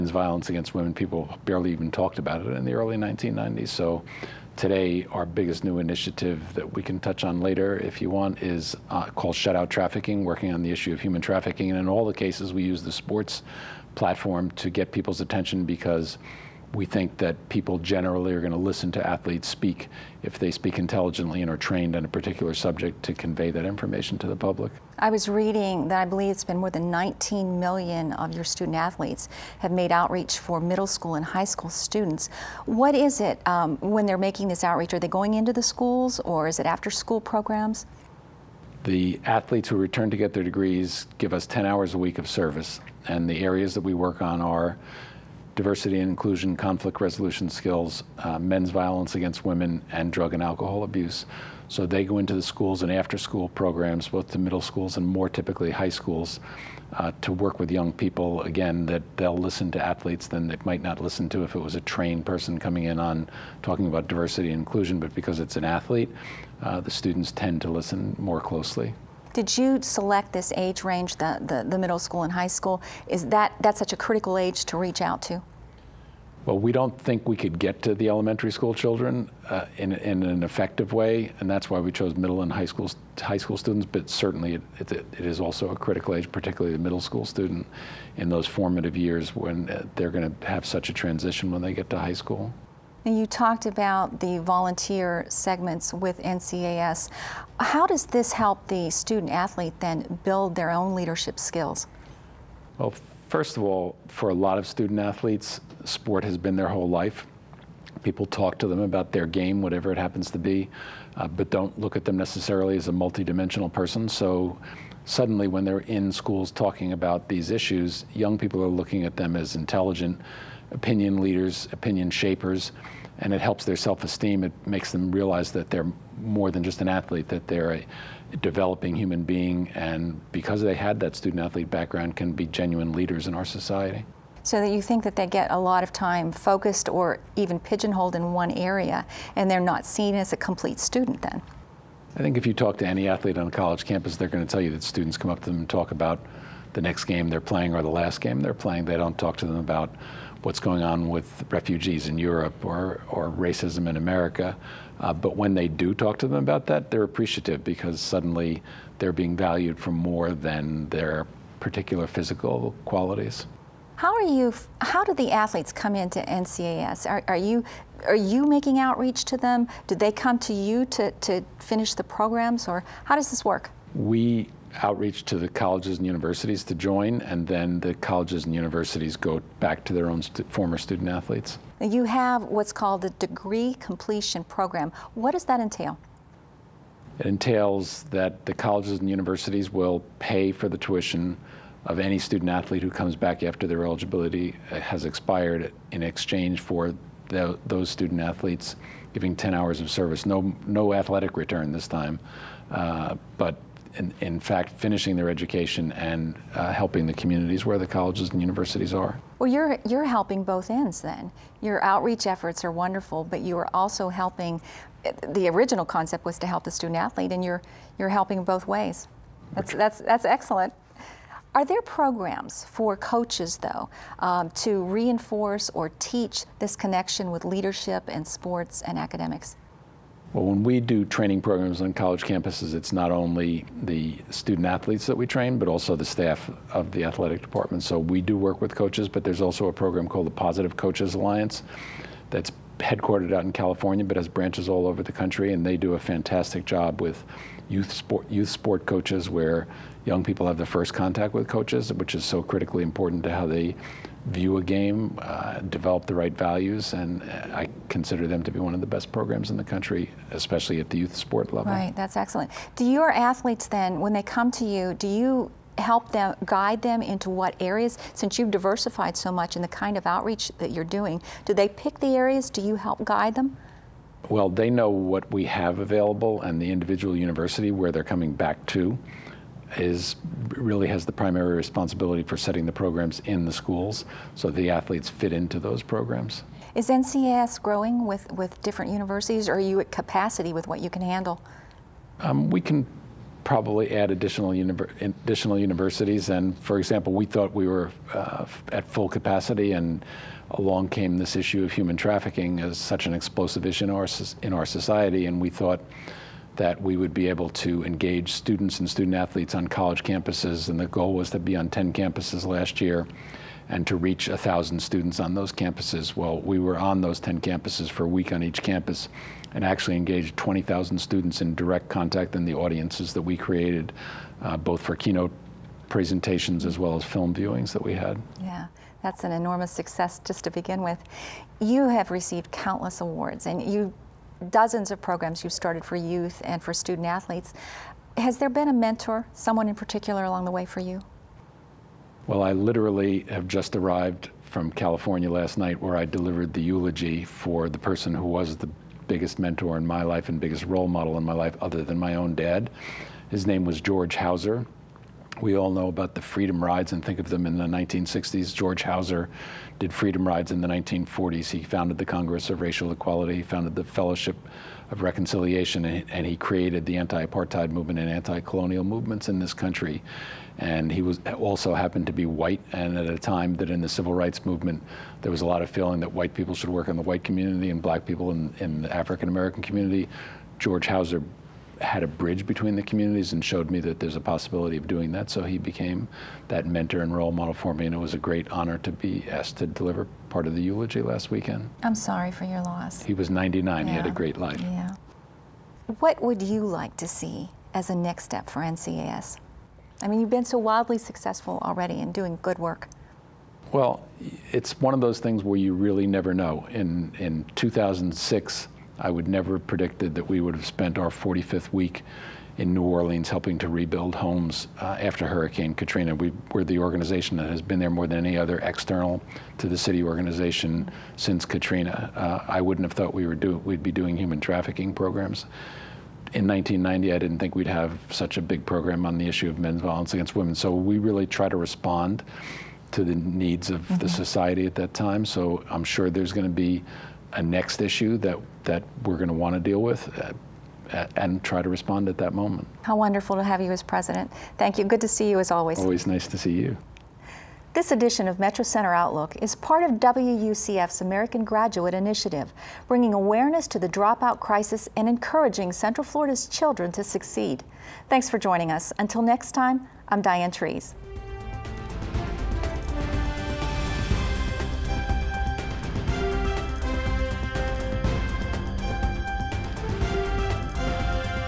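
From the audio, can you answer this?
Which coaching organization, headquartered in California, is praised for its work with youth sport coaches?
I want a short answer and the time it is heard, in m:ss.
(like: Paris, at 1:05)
Positive Coaches Alliance, at 4:00.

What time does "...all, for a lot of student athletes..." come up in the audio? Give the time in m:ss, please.
1:43.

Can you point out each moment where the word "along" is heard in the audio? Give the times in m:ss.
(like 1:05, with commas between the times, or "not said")
5:00, 5:40.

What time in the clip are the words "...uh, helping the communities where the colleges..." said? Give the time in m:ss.
3:26.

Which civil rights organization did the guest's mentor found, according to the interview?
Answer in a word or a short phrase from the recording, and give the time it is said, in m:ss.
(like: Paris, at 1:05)
Congress of Racial Equality, at 6:02.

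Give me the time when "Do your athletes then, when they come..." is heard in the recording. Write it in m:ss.
4:22.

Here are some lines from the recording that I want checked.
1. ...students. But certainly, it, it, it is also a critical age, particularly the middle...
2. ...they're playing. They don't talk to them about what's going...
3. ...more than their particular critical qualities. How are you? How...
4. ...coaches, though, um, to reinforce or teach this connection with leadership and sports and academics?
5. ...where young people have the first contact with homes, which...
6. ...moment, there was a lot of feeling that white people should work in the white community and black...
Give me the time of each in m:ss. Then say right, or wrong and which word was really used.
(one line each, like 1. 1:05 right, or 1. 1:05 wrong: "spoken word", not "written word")
1. 1:23 right
2. 2:28 right
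3. 2:39 wrong: "physical", not "critical"
4. 3:42 right
5. 4:09 wrong: "coaches", not "homes"
6. 6:14 wrong: "movement", not "moment".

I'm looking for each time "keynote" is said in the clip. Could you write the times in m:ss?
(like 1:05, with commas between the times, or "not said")
5:24.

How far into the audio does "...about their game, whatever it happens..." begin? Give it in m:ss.
1:48.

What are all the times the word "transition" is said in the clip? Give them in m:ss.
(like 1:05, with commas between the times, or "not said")
1:30.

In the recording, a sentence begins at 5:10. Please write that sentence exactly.
And the goal was to be on 10 campuses last year and to reach 1,000 students on those campuses.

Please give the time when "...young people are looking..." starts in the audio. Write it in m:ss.
1:58.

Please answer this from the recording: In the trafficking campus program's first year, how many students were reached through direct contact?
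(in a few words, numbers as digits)
20,000.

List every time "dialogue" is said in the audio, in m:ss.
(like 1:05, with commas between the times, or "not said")
not said.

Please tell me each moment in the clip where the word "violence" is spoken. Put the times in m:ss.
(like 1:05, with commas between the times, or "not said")
0:00, 0:48, 7:09.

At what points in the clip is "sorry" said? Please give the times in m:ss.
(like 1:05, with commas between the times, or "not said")
6:31.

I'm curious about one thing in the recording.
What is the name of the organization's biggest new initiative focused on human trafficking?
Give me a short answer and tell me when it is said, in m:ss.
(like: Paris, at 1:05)
Shut Out Trafficking, at 0:09.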